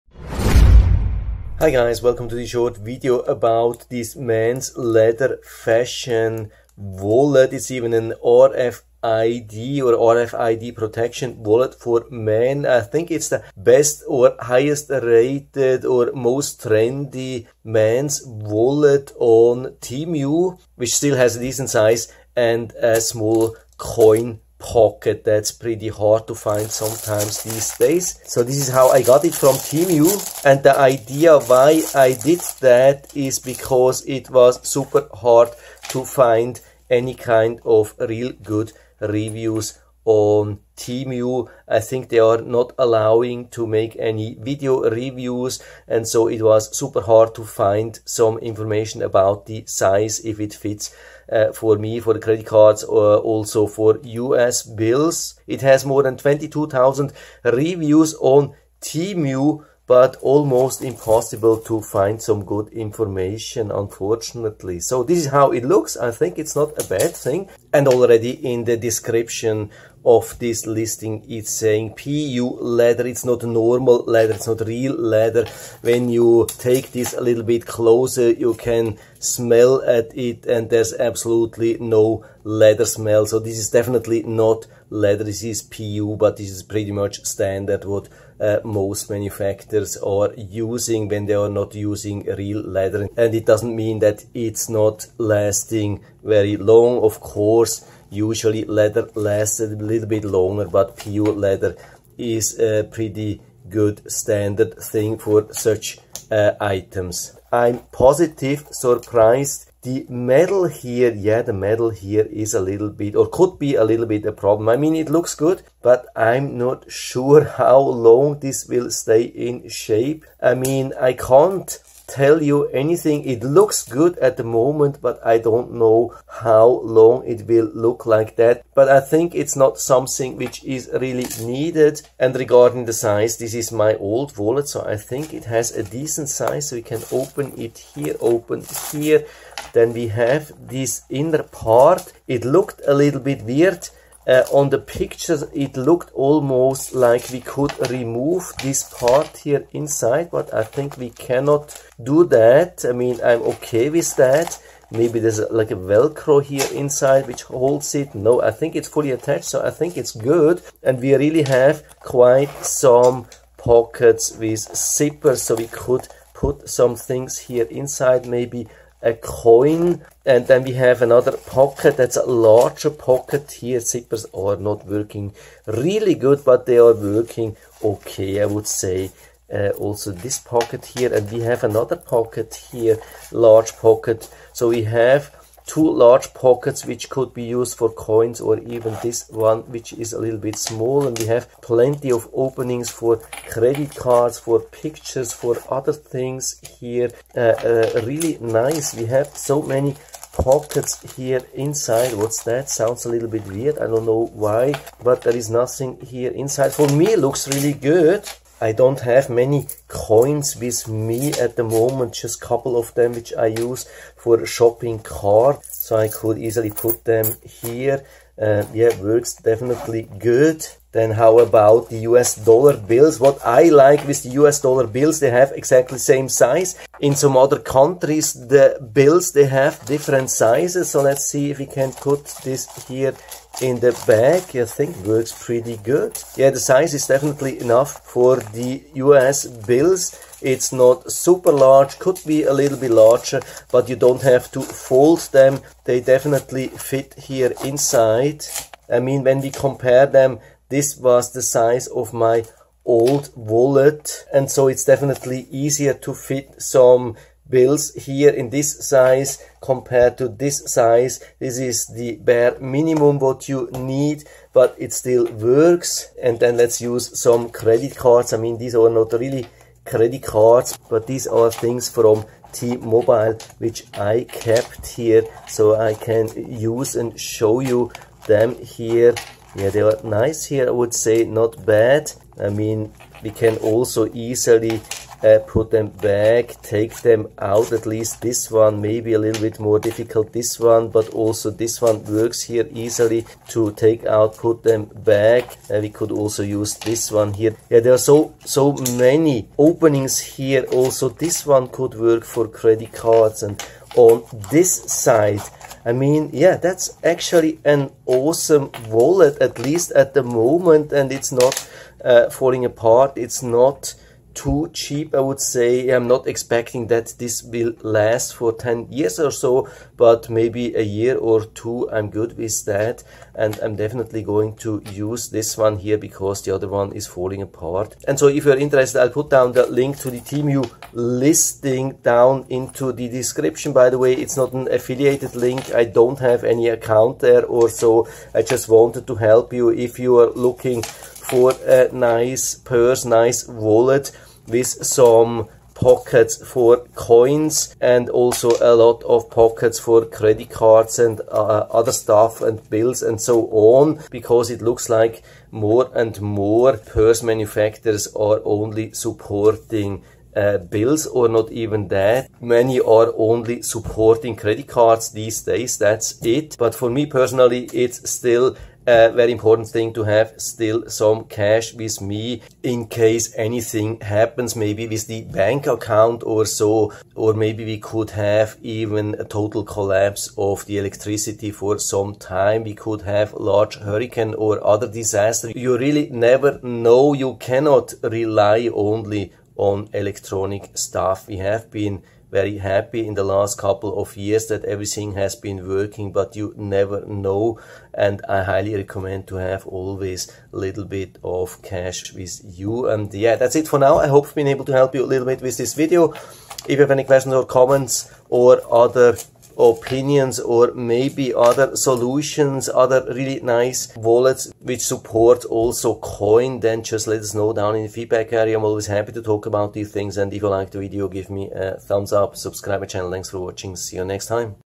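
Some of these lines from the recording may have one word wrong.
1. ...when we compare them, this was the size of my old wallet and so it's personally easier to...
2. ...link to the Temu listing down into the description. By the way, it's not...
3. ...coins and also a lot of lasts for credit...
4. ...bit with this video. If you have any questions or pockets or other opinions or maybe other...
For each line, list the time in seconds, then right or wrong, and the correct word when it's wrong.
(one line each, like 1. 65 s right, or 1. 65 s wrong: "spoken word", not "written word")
1. 249 s wrong: "definitely", not "personally"
2. 329 s right
3. 346 s wrong: "pockets", not "lasts"
4. 405 s wrong: "comments", not "pockets".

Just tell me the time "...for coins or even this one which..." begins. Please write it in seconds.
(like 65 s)
187 s.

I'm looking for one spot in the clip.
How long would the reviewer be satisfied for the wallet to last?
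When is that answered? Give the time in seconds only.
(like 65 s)
320 s.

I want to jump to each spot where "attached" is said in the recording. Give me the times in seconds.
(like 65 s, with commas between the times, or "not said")
159 s.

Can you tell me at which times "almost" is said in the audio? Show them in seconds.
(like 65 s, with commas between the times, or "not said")
60 s, 146 s.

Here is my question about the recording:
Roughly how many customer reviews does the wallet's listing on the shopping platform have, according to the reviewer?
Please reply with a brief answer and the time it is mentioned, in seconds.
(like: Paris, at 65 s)
22,000, at 56 s.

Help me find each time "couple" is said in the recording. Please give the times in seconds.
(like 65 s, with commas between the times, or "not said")
212 s, 393 s.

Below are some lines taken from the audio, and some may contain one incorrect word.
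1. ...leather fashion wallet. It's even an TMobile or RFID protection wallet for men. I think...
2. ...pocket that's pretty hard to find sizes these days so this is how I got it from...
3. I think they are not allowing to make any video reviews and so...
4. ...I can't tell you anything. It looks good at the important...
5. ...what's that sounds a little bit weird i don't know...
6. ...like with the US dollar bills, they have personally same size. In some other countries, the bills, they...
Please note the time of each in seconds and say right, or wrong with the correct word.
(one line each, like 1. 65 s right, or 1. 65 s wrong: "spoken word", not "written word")
1. 4 s wrong: "RFID", not "TMobile"
2. 24 s wrong: "sometimes", not "sizes"
3. 41 s right
4. 121 s wrong: "moment", not "important"
5. 202 s right
6. 223 s wrong: "exactly", not "personally".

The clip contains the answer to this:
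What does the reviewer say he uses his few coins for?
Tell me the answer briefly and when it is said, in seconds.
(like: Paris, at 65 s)
Shopping cart, at 214 s.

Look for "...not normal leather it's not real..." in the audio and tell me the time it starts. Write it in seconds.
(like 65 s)
73 s.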